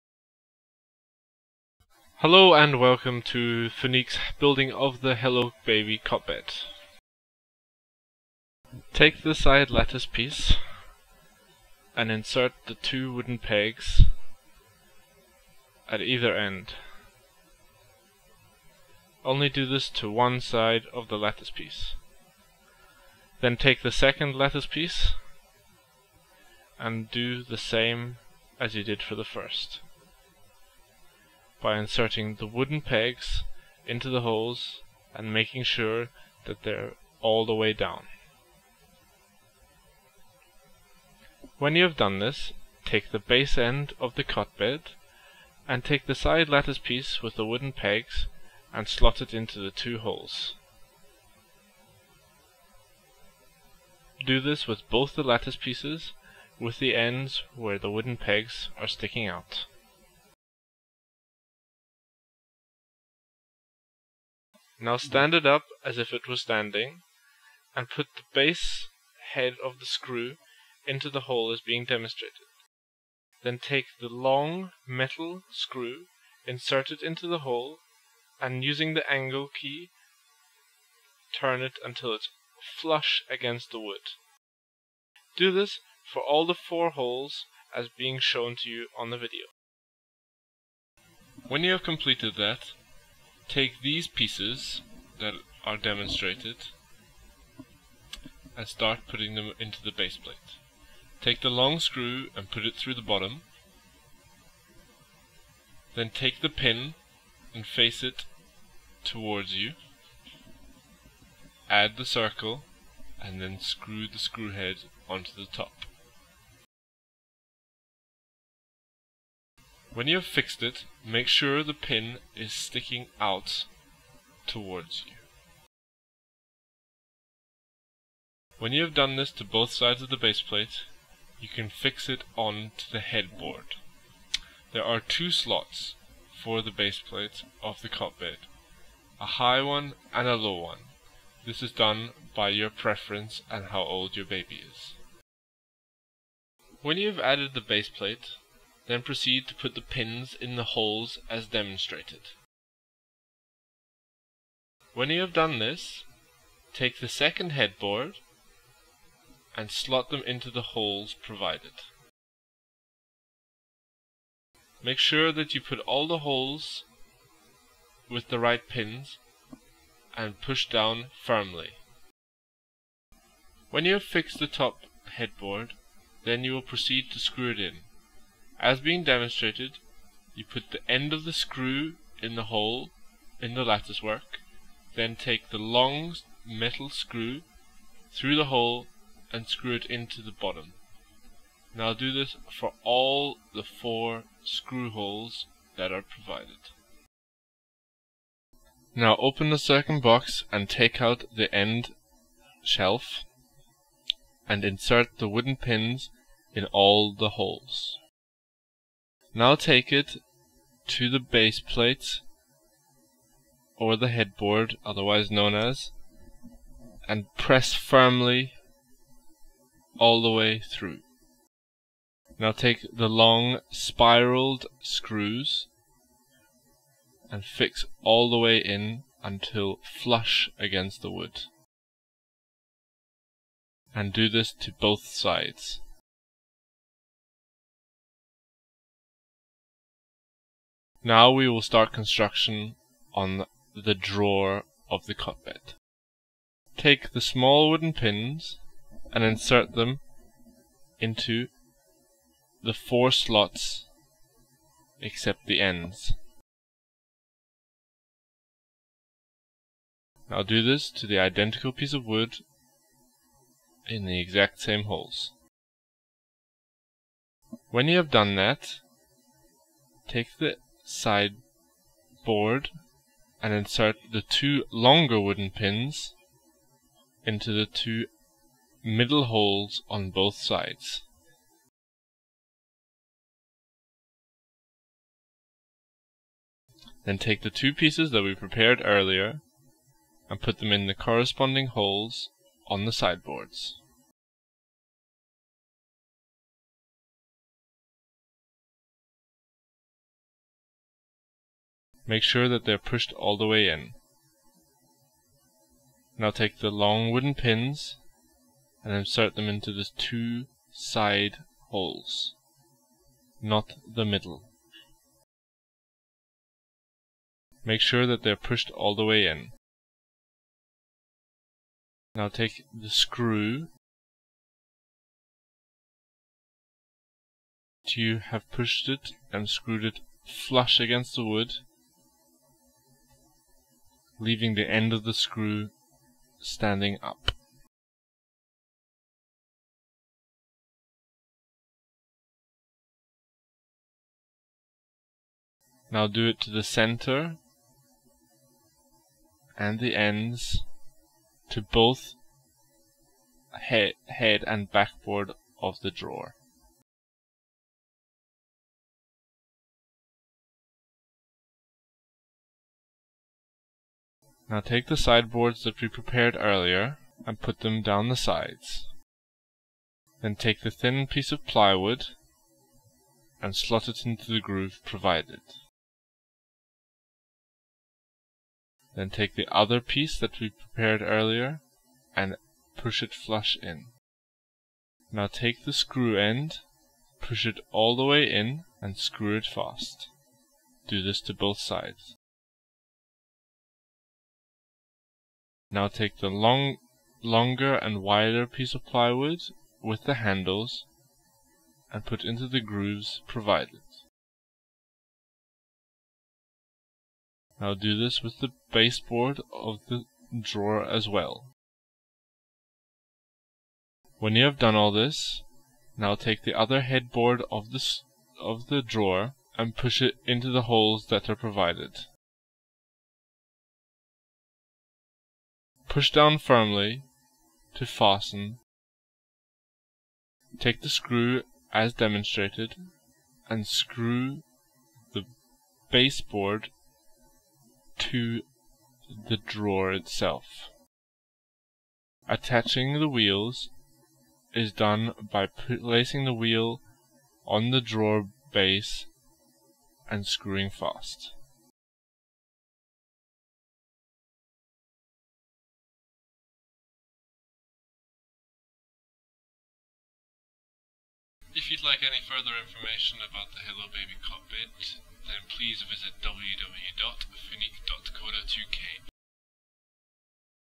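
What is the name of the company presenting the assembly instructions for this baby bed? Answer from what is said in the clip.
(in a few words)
Furnique.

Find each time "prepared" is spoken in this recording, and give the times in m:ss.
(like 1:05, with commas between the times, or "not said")
4:48, 6:05, 6:20.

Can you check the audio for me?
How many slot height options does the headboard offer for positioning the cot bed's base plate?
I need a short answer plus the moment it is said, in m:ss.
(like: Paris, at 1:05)
2, at 2:15.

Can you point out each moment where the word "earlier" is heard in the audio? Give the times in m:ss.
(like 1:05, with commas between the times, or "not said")
4:48, 6:06, 6:21.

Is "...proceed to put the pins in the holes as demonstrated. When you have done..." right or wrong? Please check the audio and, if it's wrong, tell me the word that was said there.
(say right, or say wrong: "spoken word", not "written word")
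right.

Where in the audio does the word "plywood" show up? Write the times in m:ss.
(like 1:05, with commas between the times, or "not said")
6:11, 6:38.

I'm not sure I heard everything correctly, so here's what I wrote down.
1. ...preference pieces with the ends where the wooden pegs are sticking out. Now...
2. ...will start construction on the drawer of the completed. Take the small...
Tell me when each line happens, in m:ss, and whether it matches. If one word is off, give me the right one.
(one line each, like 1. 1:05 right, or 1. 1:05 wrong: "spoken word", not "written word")
1. 0:55 wrong: "lattice", not "preference"
2. 4:01 wrong: "cotbed", not "completed".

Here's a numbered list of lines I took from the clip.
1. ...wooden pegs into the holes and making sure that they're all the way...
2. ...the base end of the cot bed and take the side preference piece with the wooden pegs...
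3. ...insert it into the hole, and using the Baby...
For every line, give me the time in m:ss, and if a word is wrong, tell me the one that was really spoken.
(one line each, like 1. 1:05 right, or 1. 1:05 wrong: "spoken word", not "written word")
1. 0:32 right
2. 0:43 wrong: "lattice", not "preference"
3. 1:16 wrong: "Allen", not "Baby".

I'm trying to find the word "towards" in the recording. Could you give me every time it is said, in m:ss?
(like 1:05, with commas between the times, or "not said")
1:49, 2:04.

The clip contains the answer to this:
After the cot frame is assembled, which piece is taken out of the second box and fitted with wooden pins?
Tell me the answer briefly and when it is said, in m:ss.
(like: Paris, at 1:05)
End shelf, at 3:21.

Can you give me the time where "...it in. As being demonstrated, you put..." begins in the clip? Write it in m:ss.
2:57.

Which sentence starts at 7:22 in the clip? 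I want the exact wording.
Attaching the wheels is done by placing the wheel on the drawer base and screwing fast.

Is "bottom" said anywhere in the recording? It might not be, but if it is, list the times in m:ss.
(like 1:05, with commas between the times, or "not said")
1:43, 3:10.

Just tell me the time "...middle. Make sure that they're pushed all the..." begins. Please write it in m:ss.
5:14.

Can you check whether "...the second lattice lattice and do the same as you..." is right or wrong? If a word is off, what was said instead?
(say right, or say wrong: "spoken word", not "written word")
wrong: "piece", not "lattice".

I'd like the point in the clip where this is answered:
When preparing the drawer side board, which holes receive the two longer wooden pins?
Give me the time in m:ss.
4:37.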